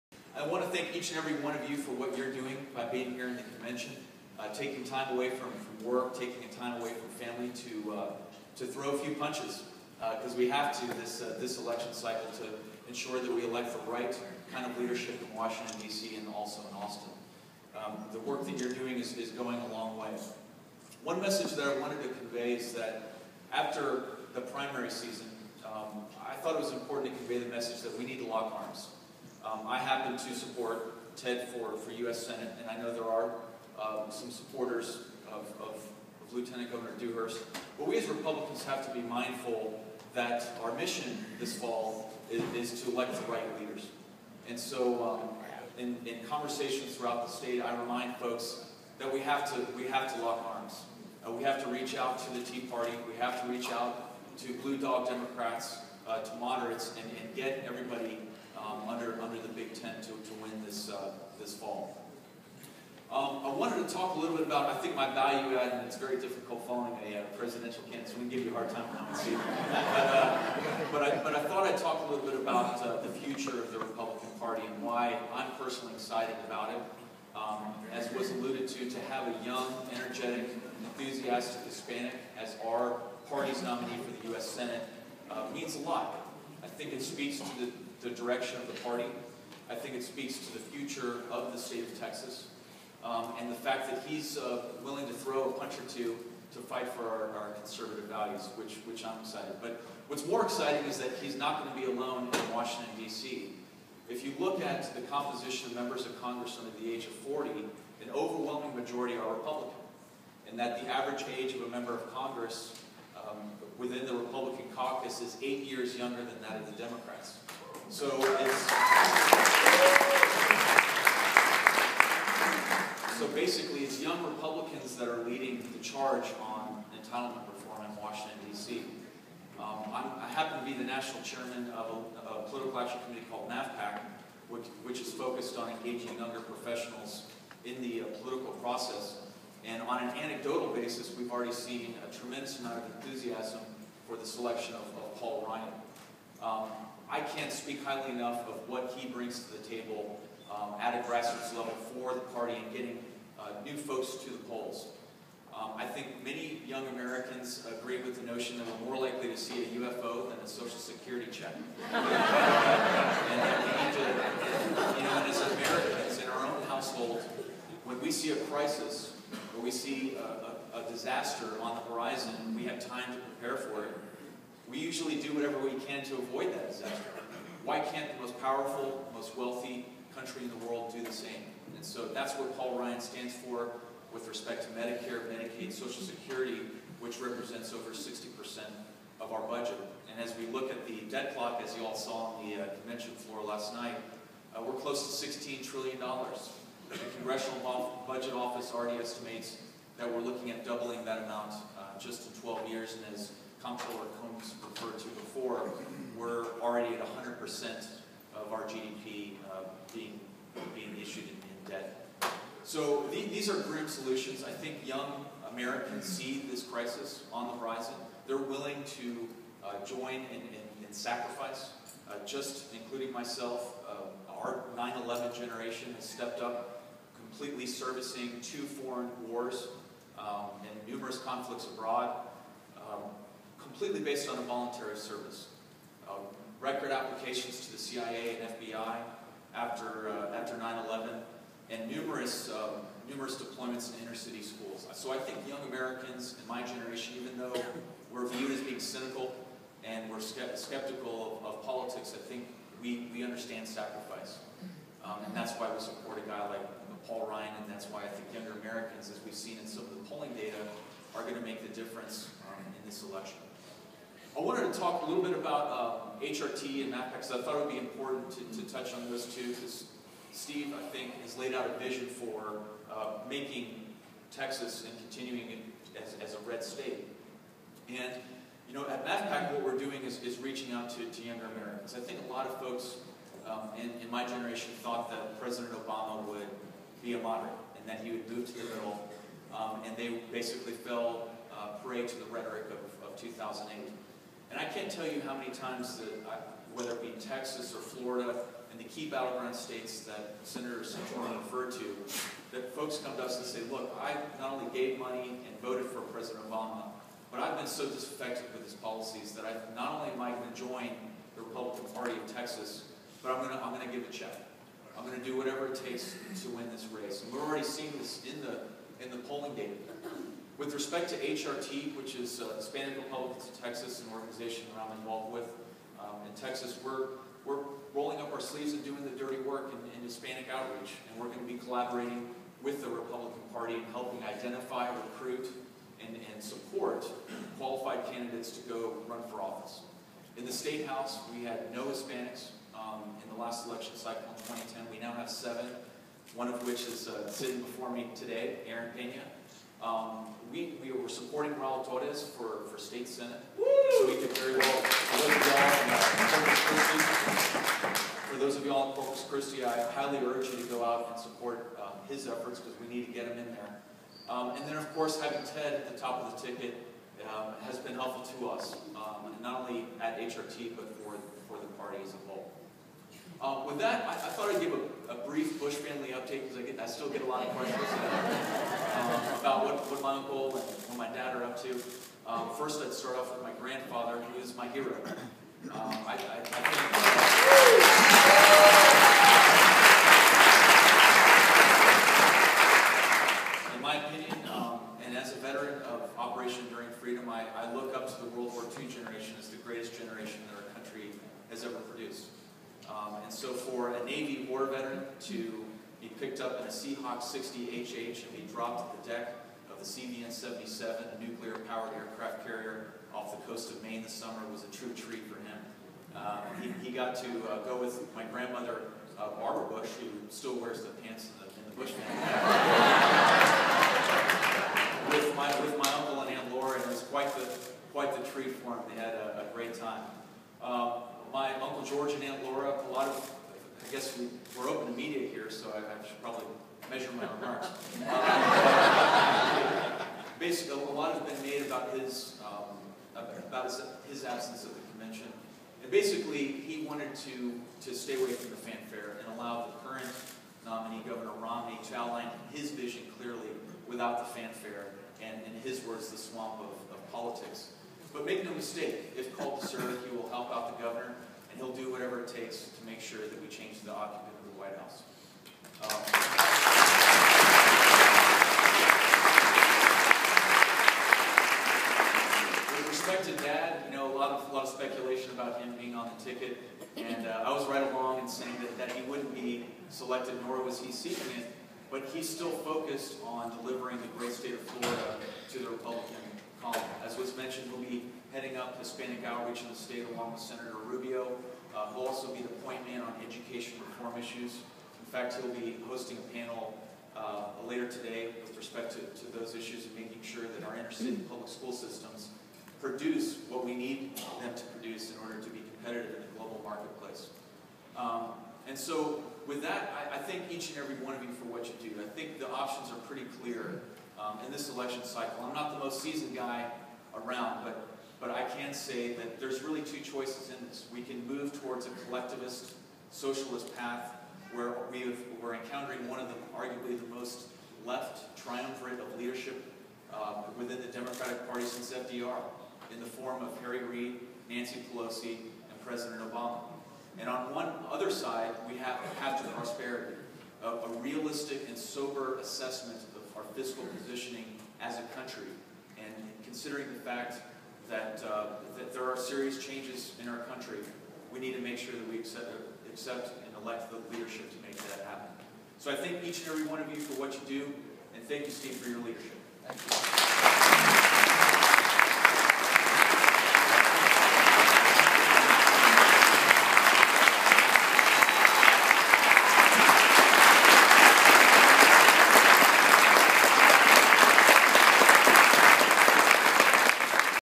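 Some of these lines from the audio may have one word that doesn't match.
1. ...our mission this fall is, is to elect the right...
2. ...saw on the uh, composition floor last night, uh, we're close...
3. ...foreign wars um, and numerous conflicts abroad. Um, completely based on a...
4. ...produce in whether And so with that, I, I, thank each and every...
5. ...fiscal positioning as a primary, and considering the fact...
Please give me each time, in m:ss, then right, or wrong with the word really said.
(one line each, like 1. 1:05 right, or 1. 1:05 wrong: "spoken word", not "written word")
1. 0:40 right
2. 3:11 wrong: "convention", not "composition"
3. 3:48 right
4. 8:24 wrong: "order", not "whether"
5. 9:03 wrong: "country", not "primary".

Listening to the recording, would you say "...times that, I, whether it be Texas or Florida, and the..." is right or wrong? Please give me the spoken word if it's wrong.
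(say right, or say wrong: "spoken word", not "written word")
right.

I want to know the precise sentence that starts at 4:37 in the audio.
And, you know, at MavPAC, what we're doing is, is reaching out to, to younger Americans.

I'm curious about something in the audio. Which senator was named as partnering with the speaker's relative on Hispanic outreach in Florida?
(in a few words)
Senator Rubio.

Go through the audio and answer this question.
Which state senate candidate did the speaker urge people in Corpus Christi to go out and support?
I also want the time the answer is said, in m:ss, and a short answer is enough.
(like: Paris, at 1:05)
Raul Torres, at 5:51.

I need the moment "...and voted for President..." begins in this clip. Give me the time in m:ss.
5:05.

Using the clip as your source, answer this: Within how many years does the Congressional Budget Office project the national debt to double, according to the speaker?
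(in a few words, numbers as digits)
12 years.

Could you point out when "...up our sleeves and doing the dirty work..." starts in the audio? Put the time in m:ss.
5:28.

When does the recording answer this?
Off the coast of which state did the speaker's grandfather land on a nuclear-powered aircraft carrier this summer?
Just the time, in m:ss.
6:53.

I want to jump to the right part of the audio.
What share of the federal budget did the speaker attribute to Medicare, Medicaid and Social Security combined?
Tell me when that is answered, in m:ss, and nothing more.
3:07.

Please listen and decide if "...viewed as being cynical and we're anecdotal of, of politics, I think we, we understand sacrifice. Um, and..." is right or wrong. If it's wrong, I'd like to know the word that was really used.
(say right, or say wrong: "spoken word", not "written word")
wrong: "skeptical", not "anecdotal".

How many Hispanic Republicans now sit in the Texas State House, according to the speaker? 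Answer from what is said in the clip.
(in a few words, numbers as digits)
7.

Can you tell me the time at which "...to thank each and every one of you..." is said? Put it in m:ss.
0:00.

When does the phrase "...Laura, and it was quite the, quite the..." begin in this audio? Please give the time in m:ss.
7:06.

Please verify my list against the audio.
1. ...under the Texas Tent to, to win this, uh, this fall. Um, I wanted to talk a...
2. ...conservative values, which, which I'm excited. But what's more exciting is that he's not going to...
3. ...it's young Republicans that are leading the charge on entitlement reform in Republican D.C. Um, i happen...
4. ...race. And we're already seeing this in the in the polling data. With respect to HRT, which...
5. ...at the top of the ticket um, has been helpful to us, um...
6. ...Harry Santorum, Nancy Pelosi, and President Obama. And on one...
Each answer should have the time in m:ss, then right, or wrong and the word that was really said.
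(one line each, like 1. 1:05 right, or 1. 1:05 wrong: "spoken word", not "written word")
1. 0:59 wrong: "Big", not "Texas"
2. 1:37 right
3. 2:03 wrong: "Washington", not "Republican"
4. 5:16 right
5. 6:05 right
6. 8:53 wrong: "Reid", not "Santorum".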